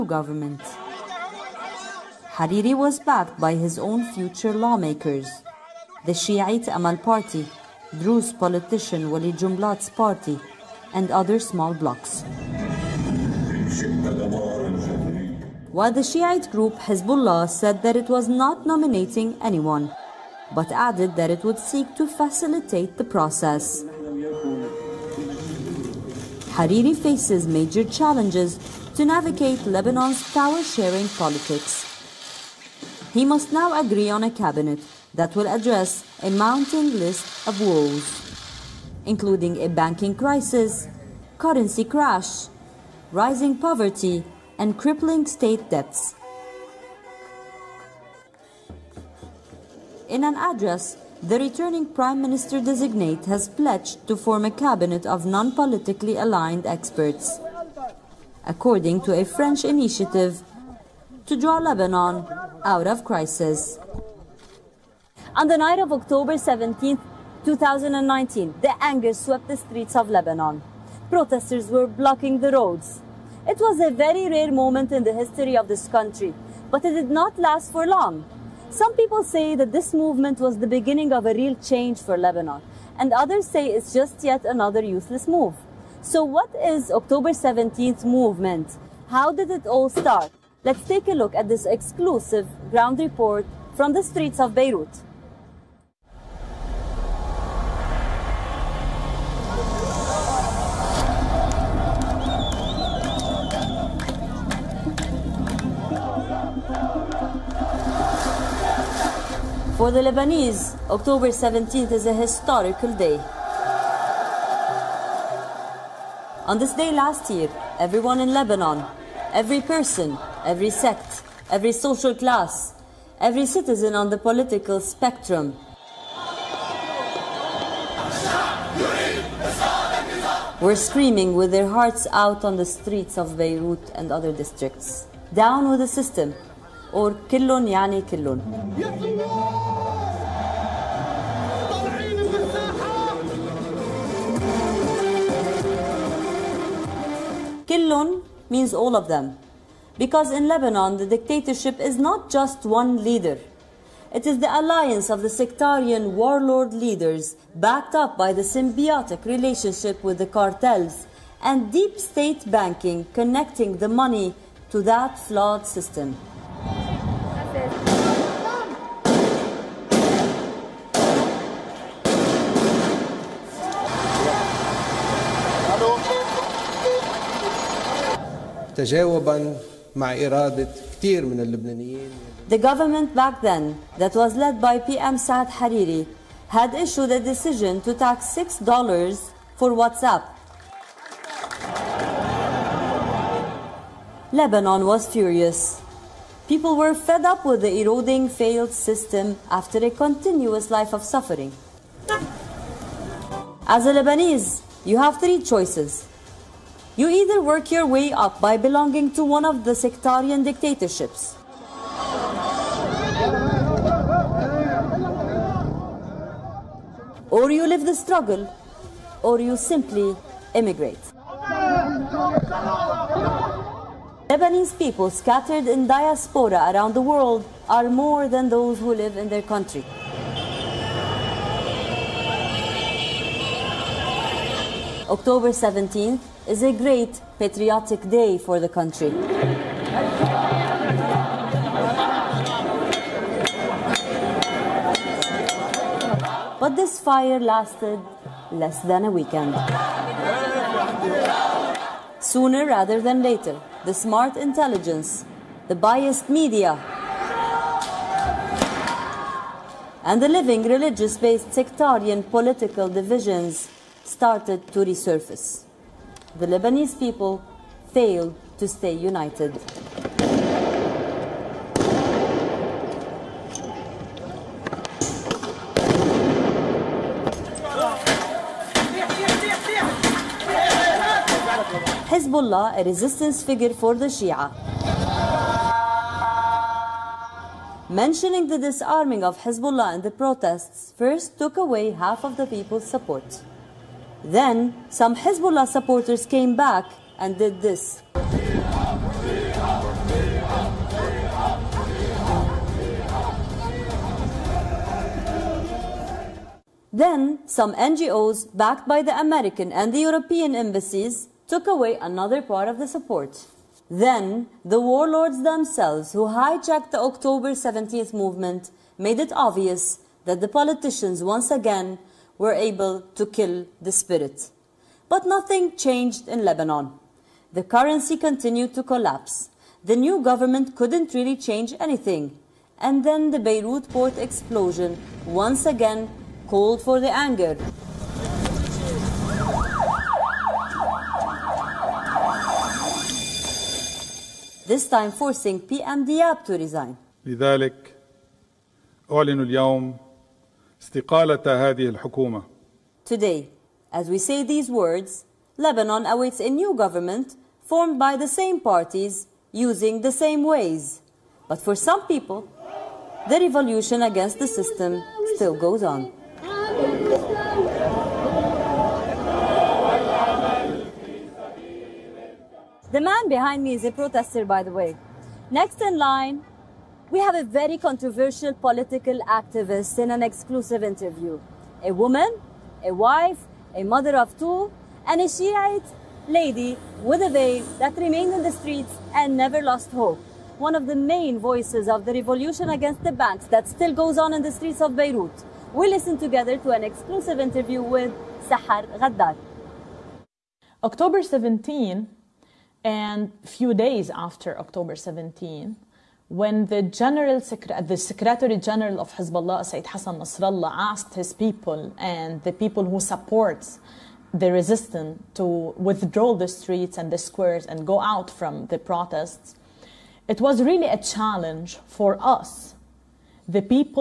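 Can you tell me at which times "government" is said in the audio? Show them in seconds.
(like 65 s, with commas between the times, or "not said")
0 s, 182 s, 330 s, 356 s.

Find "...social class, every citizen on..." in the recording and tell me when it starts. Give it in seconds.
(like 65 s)
121 s.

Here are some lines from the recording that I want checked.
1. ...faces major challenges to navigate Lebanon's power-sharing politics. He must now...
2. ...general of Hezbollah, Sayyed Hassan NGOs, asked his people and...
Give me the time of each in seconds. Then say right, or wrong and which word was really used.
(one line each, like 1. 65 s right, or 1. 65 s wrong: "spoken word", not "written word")
1. 26 s right
2. 408 s wrong: "Nasrallah", not "NGOs".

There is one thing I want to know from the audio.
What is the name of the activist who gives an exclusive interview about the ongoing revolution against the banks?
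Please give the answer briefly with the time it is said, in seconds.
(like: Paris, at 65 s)
Sahar Ghaddar, at 398 s.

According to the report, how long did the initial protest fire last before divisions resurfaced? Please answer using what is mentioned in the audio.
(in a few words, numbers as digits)
less than a weekend.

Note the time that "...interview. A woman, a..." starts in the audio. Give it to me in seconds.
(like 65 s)
380 s.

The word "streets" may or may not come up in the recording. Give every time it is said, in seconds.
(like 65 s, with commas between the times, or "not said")
69 s, 94 s, 132 s, 388 s, 394 s, 416 s.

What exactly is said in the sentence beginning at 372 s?
The man behind me is a protester, by the way.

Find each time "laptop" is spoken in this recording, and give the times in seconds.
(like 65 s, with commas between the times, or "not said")
not said.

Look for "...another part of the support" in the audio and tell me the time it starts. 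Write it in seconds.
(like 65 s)
312 s.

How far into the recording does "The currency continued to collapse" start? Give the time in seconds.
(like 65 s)
327 s.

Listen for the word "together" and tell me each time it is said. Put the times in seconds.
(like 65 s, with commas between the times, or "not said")
396 s.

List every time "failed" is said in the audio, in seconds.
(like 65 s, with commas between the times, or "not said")
198 s, 267 s.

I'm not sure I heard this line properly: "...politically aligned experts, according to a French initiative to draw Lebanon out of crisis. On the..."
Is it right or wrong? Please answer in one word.
right.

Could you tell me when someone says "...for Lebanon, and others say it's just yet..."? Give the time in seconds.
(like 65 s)
82 s.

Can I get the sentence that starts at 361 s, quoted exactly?
But for some people, the revolution against the system still goes on.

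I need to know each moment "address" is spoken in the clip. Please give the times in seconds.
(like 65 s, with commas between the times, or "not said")
35 s, 50 s.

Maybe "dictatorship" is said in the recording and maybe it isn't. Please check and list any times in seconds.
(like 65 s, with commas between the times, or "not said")
151 s, 210 s.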